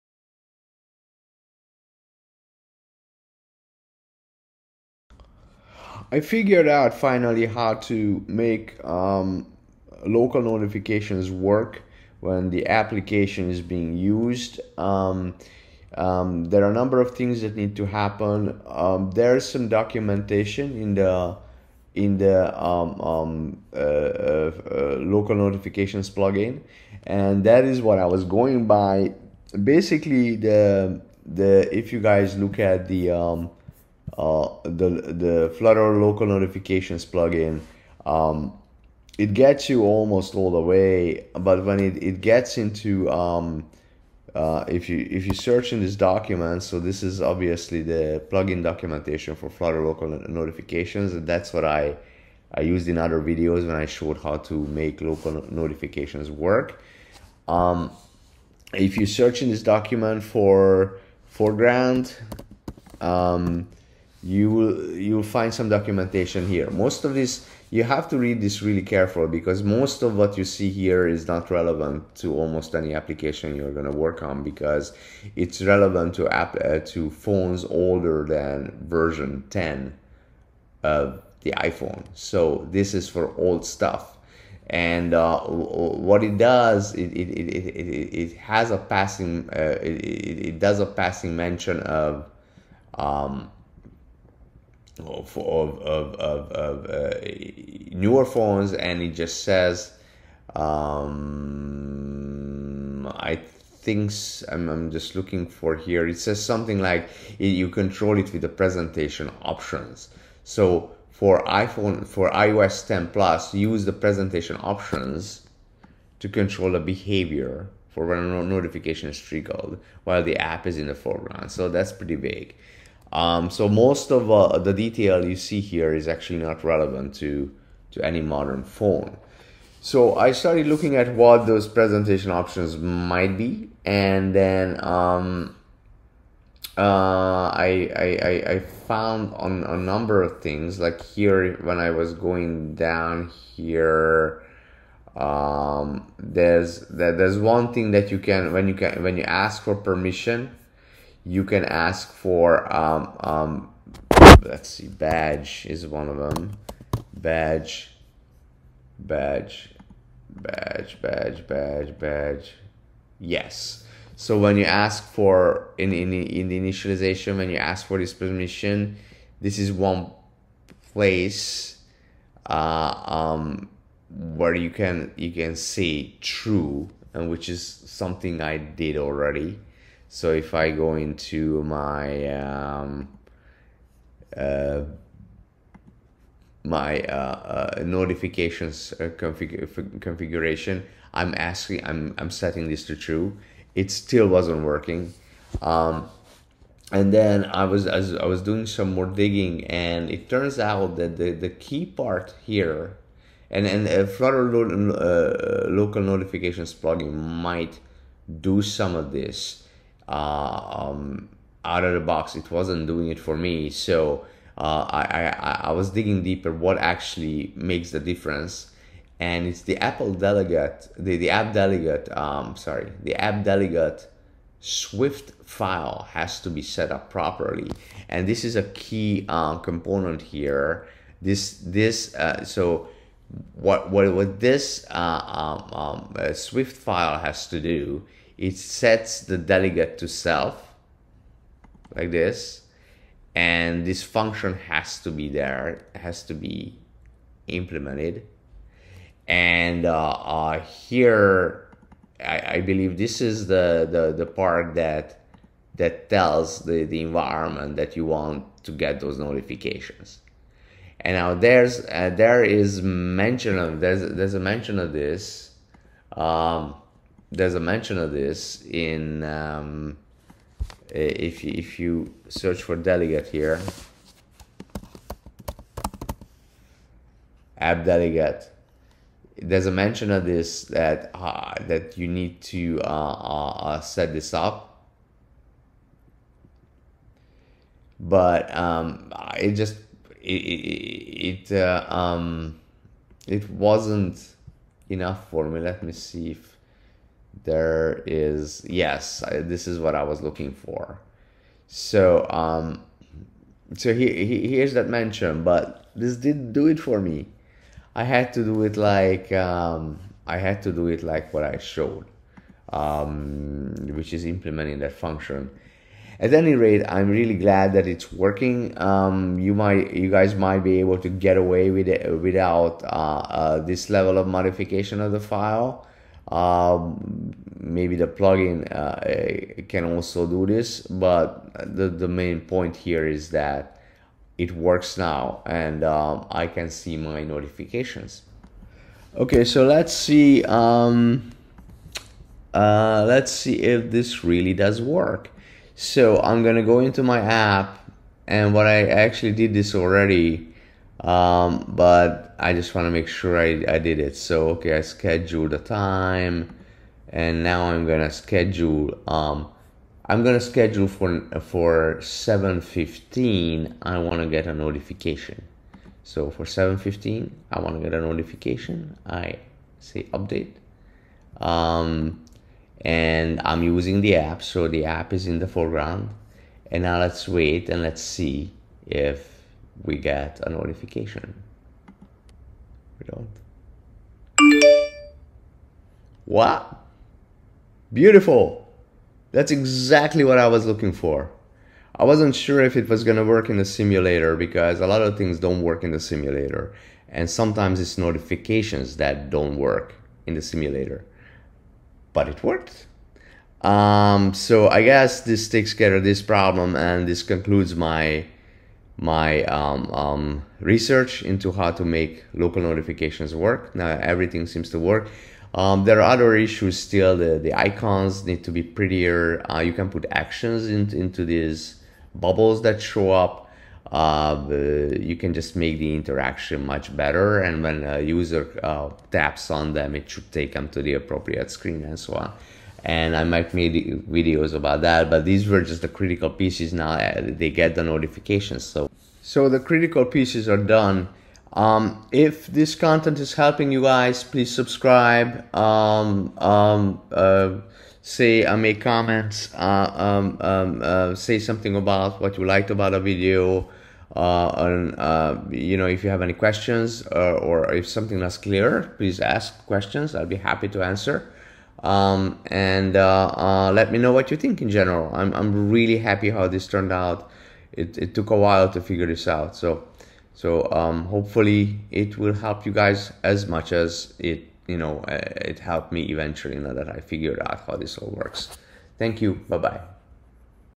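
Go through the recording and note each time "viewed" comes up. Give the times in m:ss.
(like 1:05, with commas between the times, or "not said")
not said.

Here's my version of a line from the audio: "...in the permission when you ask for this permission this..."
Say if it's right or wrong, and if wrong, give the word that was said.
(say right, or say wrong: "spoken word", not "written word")
wrong: "initialization", not "permission".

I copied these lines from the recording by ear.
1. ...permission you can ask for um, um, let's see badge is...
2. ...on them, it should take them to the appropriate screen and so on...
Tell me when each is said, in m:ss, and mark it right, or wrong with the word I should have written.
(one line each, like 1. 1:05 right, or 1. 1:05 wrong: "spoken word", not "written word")
1. 2:29 right
2. 7:09 right.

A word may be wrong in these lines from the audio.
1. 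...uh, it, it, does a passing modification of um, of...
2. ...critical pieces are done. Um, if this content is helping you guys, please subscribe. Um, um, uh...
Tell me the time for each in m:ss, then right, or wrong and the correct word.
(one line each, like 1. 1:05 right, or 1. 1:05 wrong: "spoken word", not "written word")
1. 1:29 wrong: "mention", not "modification"
2. 7:19 right.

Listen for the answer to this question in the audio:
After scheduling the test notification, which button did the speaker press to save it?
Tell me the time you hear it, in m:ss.
6:10.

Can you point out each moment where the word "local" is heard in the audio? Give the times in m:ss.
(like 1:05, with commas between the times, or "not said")
0:10, 0:24, 0:35, 0:49, 0:54, 3:25, 6:52.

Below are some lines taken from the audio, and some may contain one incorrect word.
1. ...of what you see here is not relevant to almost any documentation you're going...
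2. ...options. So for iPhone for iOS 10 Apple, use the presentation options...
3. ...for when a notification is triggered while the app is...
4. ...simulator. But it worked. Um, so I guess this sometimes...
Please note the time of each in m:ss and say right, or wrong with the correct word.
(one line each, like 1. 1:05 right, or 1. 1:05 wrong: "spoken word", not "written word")
1. 1:10 wrong: "application", not "documentation"
2. 1:49 wrong: "Plus", not "Apple"
3. 1:57 right
4. 6:40 wrong: "takes", not "sometimes".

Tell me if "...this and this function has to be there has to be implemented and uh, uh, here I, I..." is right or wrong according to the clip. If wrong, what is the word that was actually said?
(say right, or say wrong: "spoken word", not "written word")
right.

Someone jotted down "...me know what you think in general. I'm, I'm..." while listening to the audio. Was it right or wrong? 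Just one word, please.
right.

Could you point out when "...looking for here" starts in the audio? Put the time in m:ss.
1:45.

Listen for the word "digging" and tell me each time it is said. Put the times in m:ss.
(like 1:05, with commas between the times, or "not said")
3:19, 3:35.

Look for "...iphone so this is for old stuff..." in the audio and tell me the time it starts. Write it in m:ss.
1:21.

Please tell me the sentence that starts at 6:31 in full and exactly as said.
I wasn't sure if it was gonna work in the simulator because a lot of things don't work in the simulator.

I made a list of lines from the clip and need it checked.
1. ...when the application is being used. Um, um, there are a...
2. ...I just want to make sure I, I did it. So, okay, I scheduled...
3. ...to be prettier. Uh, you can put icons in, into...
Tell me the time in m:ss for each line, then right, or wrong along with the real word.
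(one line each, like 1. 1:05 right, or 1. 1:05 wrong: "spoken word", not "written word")
1. 0:12 right
2. 5:52 right
3. 6:58 wrong: "actions", not "icons".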